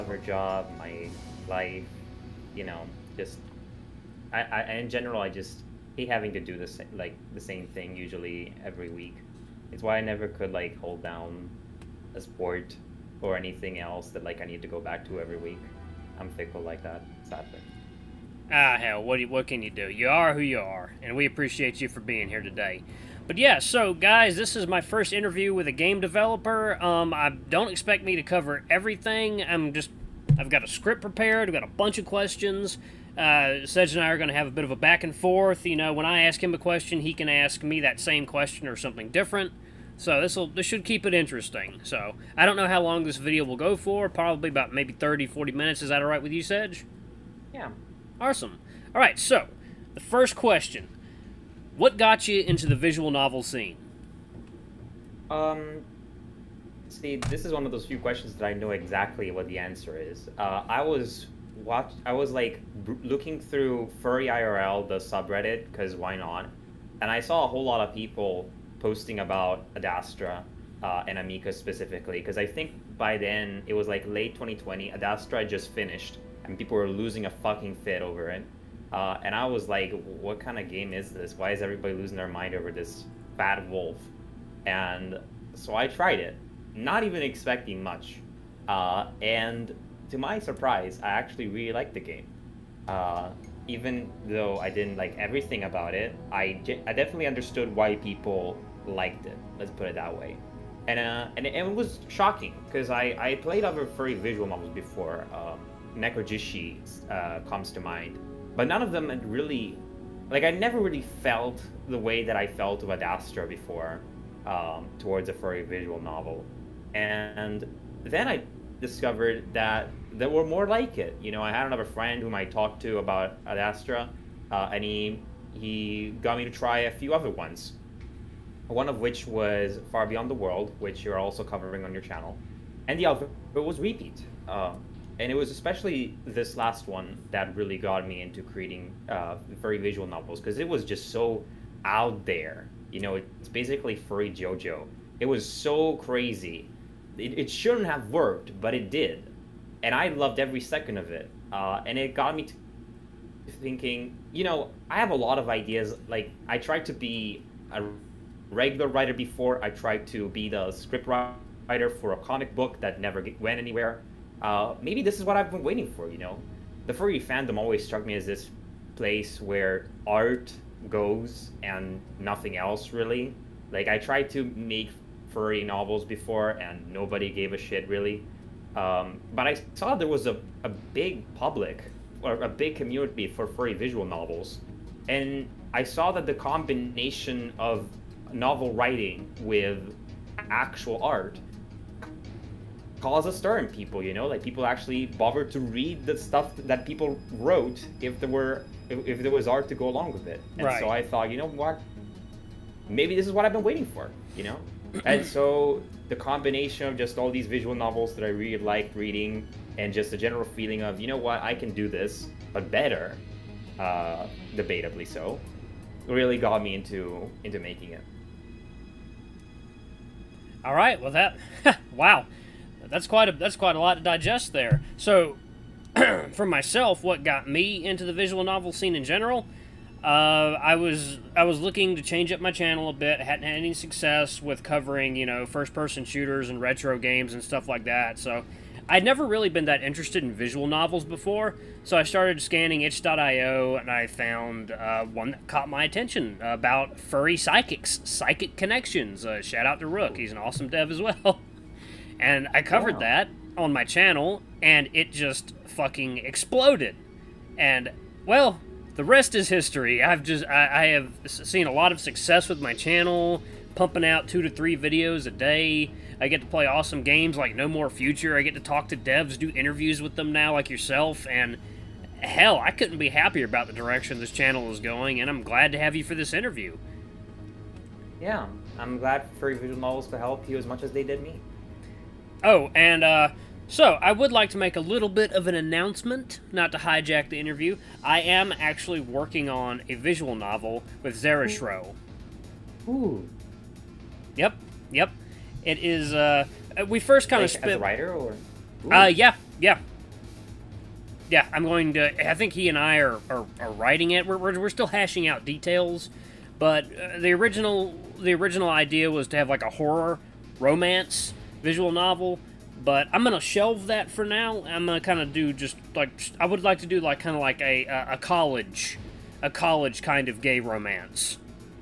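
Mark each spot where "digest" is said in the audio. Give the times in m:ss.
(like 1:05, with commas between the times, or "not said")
3:44.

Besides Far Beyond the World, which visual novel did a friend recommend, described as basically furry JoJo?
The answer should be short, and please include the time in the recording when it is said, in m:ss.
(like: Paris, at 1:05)
Repeat, at 2:13.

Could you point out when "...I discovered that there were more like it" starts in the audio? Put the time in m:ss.
1:58.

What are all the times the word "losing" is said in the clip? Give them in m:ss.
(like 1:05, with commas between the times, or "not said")
1:16, 1:21.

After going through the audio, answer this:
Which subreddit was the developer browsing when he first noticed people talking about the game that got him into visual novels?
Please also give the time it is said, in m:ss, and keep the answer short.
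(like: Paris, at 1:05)
furry IRL, at 1:04.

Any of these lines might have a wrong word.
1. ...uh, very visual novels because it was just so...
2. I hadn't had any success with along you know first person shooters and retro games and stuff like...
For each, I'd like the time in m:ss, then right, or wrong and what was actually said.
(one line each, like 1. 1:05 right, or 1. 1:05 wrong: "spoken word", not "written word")
1. 2:19 right
2. 3:53 wrong: "covering", not "along".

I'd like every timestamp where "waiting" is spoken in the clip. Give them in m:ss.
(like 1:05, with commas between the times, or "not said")
2:45, 3:23.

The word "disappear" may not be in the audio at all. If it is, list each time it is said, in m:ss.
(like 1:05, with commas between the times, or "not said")
not said.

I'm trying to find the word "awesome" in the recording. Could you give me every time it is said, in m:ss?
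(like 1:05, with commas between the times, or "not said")
0:48, 4:10, 4:26.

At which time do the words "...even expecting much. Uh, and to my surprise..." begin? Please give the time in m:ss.
1:27.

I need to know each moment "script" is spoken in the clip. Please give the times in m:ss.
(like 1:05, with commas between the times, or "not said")
0:30, 2:40.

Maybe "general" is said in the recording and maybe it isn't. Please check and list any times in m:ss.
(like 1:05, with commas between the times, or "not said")
0:04, 3:30, 3:49.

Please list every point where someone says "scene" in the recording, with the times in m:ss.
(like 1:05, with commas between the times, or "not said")
0:53, 3:48.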